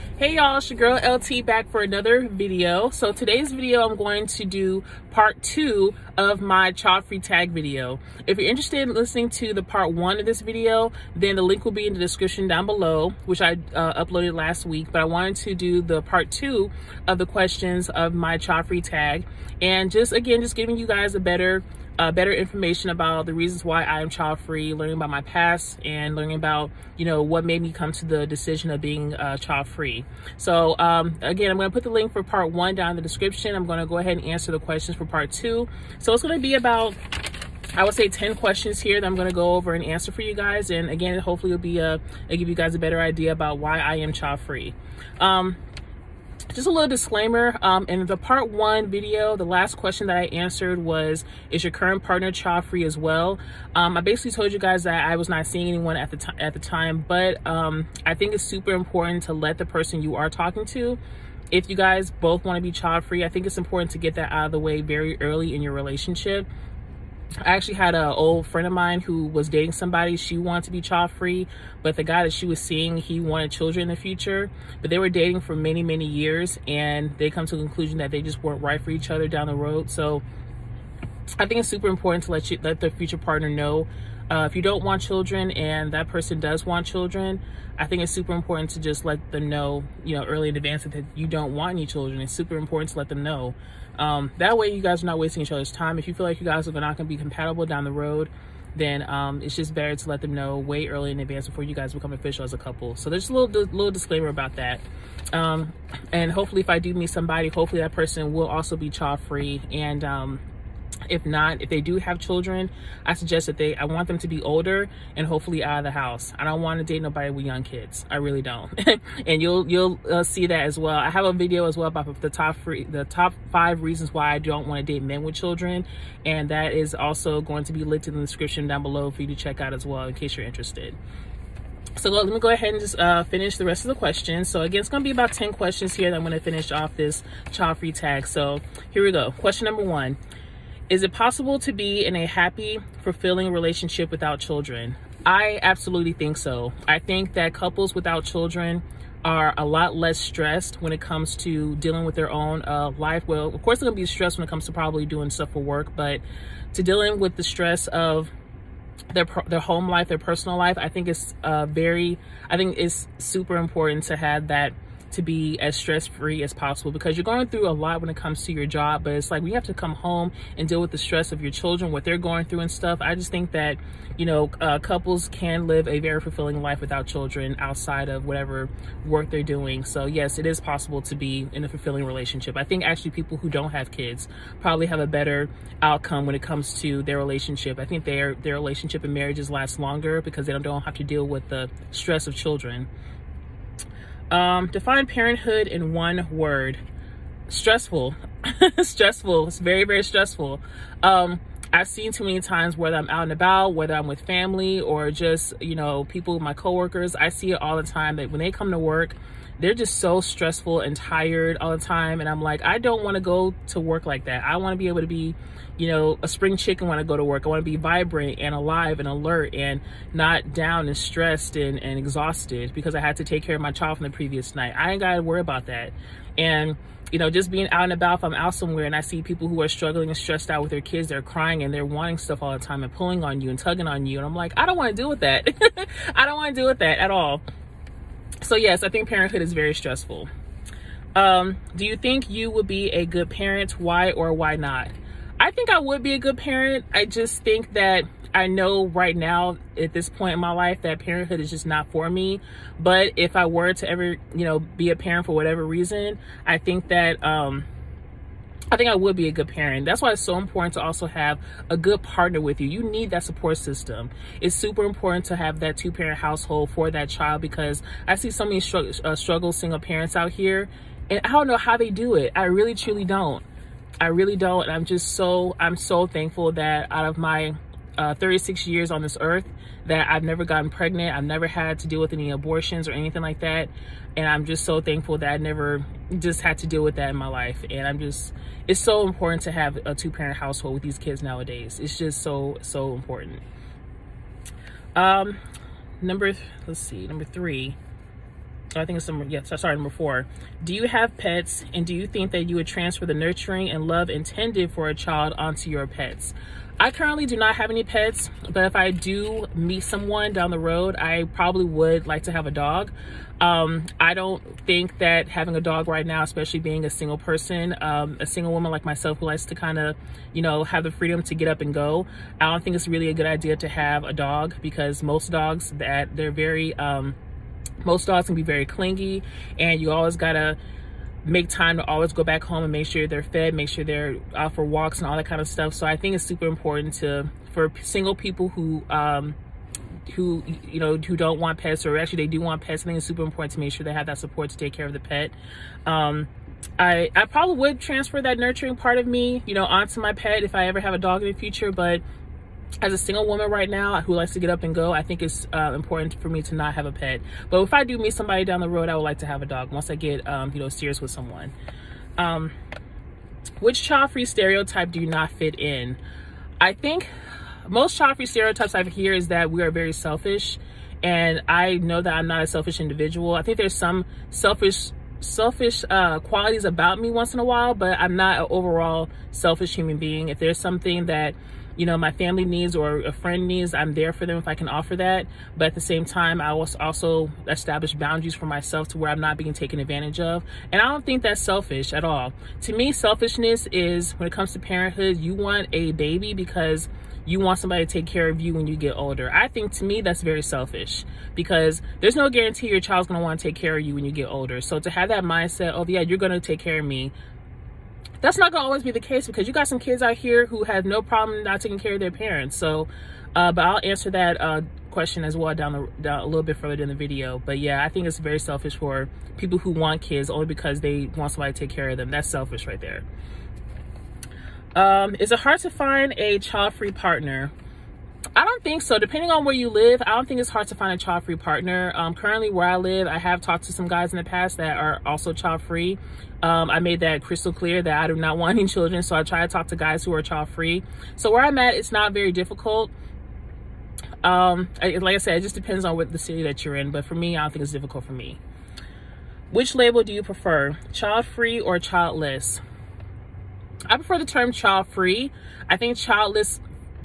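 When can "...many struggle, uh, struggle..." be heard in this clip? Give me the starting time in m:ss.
4:28.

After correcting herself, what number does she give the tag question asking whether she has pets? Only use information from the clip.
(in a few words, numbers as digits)
4.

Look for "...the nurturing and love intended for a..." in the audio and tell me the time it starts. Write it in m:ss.
5:03.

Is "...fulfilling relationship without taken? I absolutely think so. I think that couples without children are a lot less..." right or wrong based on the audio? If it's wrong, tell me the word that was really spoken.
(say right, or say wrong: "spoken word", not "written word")
wrong: "children", not "taken".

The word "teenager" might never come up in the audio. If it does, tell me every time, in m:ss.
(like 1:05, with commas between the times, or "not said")
not said.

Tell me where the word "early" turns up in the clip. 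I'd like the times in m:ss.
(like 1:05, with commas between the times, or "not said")
1:05, 1:30, 1:40.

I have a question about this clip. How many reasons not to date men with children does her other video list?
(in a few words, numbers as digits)
5.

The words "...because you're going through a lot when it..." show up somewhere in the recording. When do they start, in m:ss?
2:46.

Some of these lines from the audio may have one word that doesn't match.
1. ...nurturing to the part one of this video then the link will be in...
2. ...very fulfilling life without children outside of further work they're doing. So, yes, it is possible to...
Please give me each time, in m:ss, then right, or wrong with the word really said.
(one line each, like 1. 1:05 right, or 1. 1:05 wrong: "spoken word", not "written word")
1. 0:08 wrong: "listening", not "nurturing"
2. 2:55 wrong: "whatever", not "further".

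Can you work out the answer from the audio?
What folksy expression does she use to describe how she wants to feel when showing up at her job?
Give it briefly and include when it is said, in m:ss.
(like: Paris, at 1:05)
spring chicken, at 3:36.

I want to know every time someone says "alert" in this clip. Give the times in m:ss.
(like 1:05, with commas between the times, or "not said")
3:39.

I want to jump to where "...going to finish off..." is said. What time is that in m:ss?
2:16.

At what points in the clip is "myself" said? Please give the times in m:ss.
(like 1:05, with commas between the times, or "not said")
5:18, 6:28.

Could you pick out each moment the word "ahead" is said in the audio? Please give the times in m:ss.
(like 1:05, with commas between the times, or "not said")
0:33, 2:12.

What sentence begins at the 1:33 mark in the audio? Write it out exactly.
Um, that way you guys are not wasting each other's time.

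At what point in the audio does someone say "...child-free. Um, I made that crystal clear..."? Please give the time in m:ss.
7:15.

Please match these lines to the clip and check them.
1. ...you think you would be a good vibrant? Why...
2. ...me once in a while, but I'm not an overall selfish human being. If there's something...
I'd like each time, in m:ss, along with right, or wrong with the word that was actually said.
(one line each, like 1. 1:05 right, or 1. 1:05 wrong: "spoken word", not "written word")
1. 4:01 wrong: "parent", not "vibrant"
2. 6:16 right.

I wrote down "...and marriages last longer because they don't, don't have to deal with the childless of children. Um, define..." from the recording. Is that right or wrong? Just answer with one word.
wrong.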